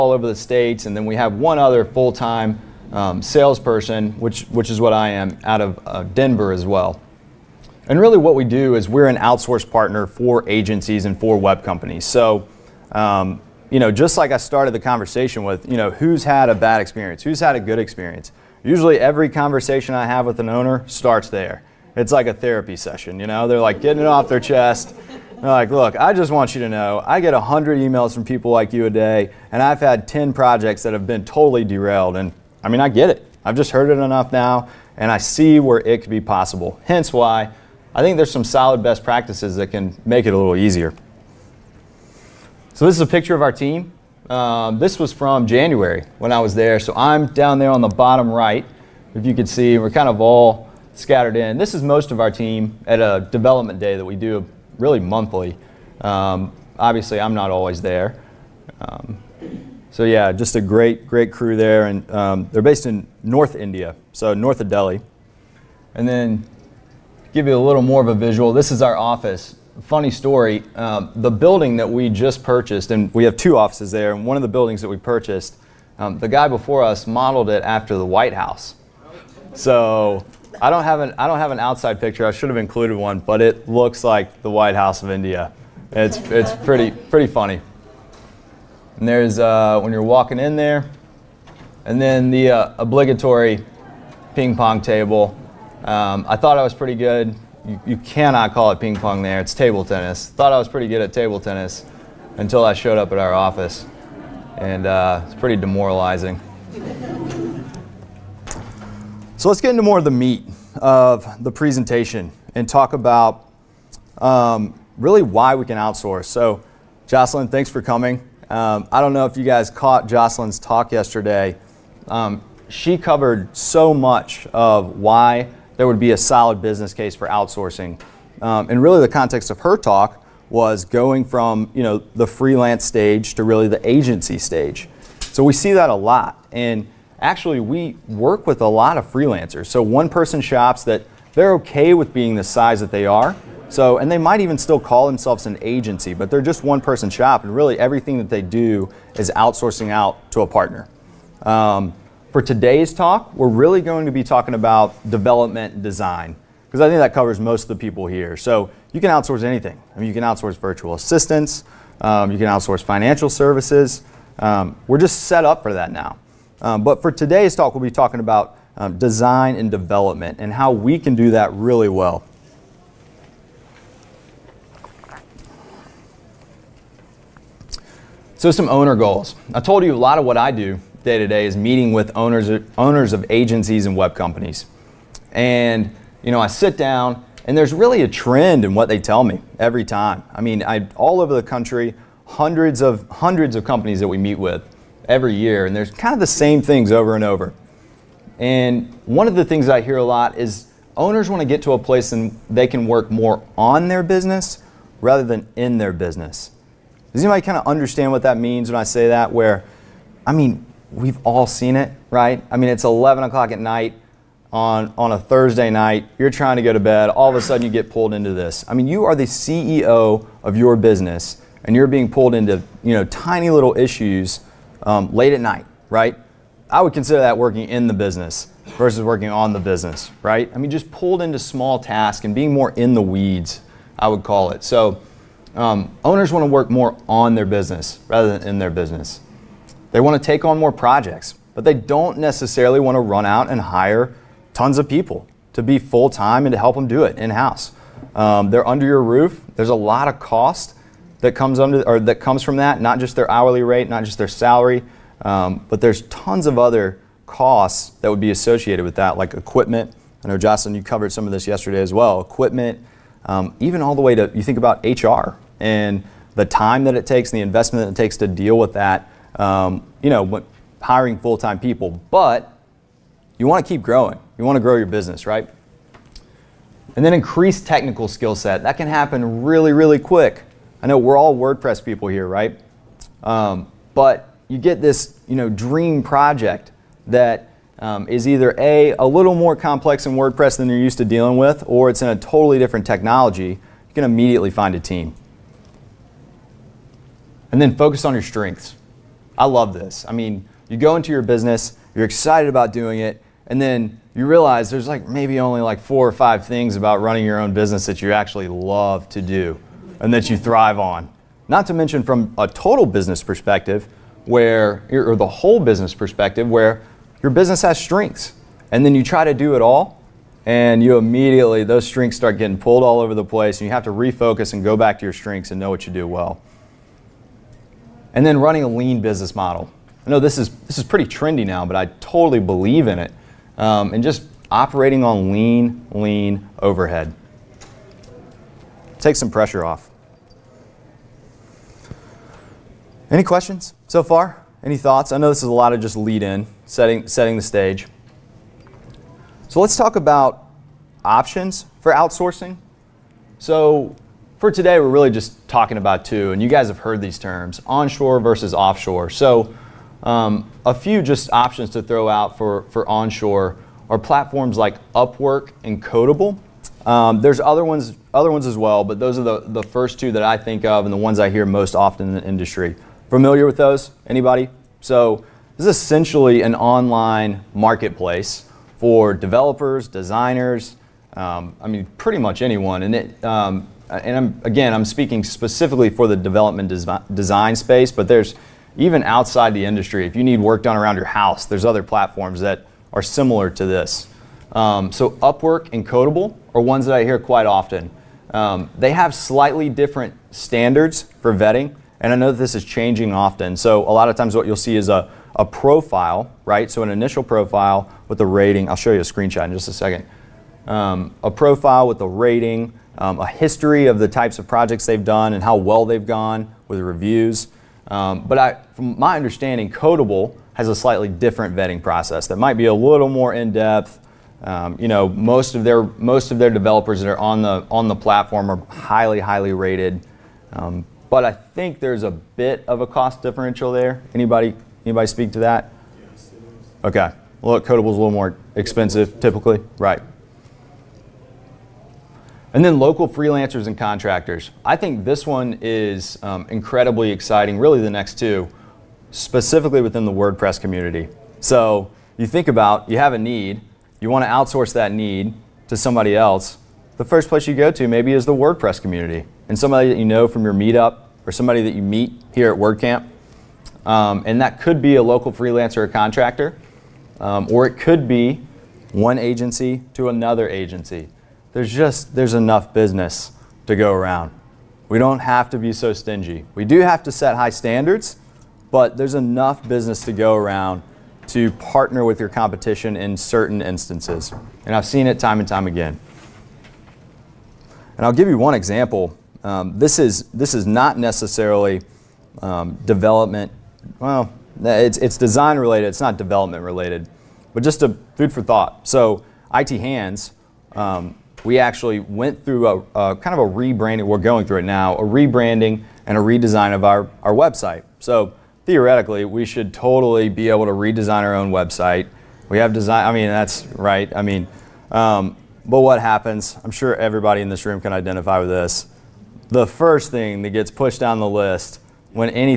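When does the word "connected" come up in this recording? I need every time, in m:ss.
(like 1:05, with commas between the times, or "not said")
not said.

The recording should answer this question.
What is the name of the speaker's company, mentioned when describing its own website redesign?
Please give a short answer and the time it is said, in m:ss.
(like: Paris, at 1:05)
IT Hands, at 8:19.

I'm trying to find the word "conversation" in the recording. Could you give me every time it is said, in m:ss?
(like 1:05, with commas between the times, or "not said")
0:14, 0:19.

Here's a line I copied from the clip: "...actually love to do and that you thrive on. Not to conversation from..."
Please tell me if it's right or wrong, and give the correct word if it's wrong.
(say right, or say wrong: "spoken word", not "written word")
wrong: "mention", not "conversation".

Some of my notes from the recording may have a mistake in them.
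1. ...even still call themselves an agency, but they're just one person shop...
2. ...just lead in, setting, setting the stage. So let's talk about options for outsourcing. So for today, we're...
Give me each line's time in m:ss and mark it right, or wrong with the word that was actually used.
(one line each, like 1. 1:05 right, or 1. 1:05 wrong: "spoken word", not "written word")
1. 2:24 right
2. 5:45 right.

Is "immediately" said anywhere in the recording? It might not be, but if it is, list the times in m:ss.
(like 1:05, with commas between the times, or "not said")
4:54, 5:20.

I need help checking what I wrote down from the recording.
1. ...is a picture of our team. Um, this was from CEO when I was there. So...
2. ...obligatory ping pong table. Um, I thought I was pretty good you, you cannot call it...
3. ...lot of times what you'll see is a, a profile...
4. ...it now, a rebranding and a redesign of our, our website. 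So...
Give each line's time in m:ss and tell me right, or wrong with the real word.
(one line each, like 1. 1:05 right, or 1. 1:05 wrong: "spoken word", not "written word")
1. 0:42 wrong: "January", not "CEO"
2. 1:32 right
3. 6:43 right
4. 8:24 right.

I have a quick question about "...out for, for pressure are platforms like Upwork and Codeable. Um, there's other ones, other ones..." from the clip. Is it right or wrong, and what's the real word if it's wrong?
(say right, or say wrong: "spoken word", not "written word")
wrong: "onshore", not "pressure".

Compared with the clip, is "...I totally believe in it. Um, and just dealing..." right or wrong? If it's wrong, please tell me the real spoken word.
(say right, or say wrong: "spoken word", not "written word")
wrong: "operating", not "dealing".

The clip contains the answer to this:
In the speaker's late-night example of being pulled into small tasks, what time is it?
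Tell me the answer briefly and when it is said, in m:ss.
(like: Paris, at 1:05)
11 o'clock, at 3:32.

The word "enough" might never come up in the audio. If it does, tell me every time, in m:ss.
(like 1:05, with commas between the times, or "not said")
0:34, 7:52, 7:59.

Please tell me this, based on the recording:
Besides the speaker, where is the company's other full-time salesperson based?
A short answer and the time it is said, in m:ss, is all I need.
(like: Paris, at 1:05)
Denver, at 0:06.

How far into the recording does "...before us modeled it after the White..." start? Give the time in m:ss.
1:16.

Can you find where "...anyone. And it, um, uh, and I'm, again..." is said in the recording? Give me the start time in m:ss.
6:22.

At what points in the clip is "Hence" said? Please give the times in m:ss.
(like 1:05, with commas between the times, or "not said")
0:36.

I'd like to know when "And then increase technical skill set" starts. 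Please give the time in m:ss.
4:36.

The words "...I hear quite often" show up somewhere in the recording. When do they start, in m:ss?
6:36.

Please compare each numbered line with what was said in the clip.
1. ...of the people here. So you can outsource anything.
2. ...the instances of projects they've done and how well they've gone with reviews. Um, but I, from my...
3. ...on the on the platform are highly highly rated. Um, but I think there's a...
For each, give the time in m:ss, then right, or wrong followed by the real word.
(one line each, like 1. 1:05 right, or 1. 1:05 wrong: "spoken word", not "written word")
1. 2:37 right
2. 6:53 wrong: "types", not "instances"
3. 7:07 right.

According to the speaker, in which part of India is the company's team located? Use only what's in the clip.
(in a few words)
North India.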